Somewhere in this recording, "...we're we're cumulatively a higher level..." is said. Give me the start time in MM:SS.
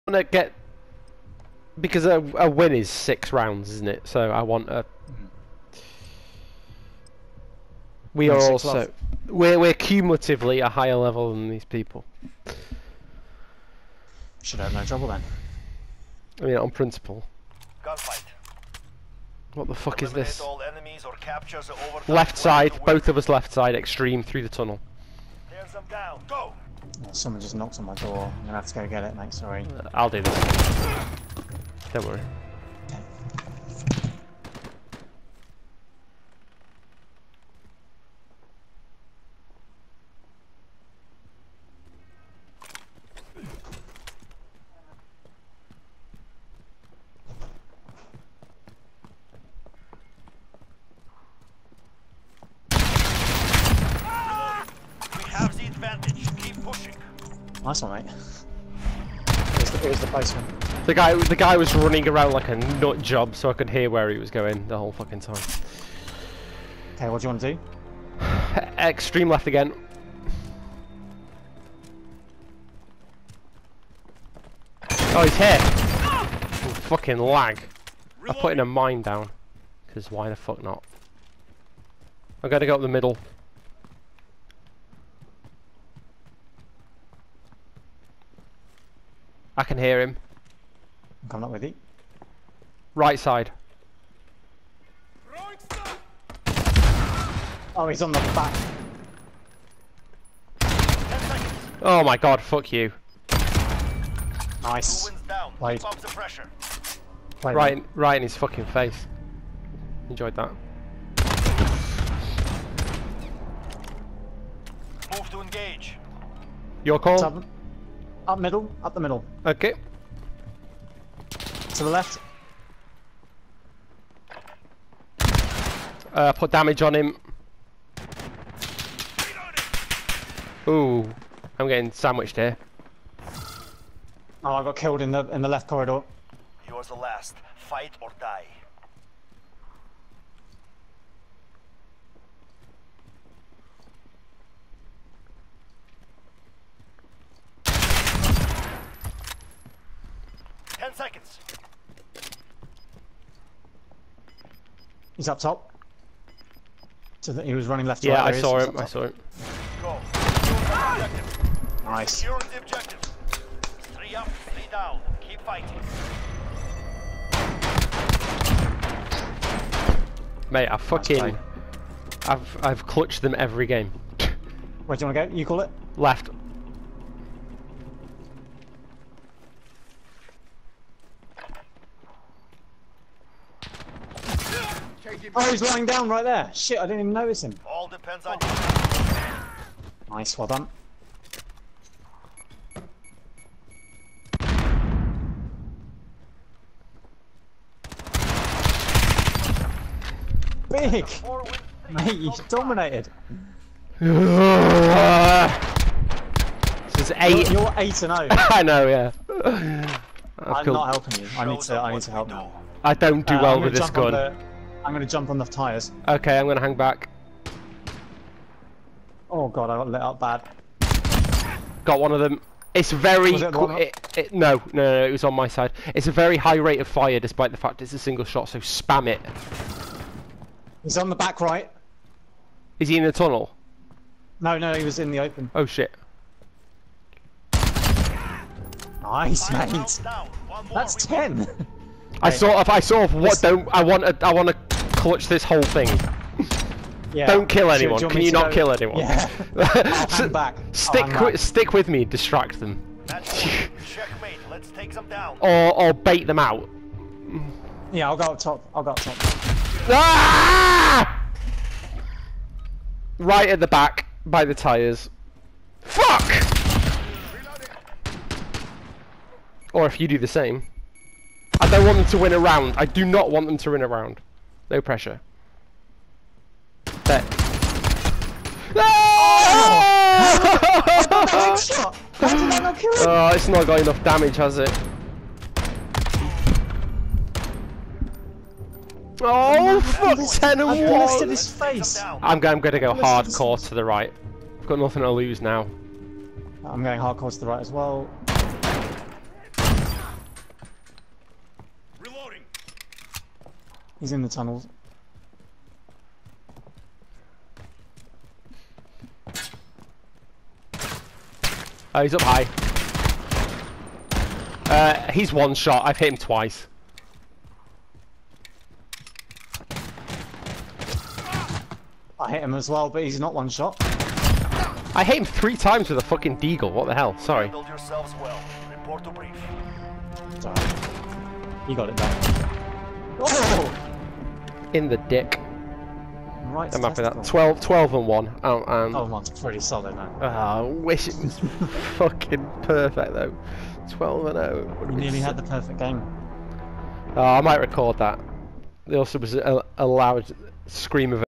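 00:09.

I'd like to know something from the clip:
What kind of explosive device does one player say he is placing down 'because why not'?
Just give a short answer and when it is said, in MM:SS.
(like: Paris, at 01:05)
a mine, at 01:18.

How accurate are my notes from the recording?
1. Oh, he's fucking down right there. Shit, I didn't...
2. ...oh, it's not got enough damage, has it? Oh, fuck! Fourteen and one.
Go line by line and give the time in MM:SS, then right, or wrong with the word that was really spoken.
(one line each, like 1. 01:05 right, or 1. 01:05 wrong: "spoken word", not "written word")
1. 03:05 wrong: "lying", not "fucking"
2. 04:43 wrong: "Ten", not "Fourteen".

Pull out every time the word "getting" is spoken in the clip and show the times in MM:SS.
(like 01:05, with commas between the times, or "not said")
02:11.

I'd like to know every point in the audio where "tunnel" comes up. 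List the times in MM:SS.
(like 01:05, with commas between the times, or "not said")
00:24, 03:53, 05:04.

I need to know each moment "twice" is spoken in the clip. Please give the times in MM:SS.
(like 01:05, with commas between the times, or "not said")
05:16.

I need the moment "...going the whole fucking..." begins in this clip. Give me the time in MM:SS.
01:04.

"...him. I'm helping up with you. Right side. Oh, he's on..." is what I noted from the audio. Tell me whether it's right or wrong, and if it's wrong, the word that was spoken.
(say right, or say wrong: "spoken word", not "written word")
wrong: "coming", not "helping".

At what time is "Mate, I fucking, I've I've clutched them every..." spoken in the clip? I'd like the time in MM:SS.
02:50.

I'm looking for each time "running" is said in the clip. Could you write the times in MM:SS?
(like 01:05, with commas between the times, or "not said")
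01:01, 02:37.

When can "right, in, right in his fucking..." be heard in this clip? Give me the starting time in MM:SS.
01:47.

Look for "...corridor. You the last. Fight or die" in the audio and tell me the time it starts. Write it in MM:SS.
02:15.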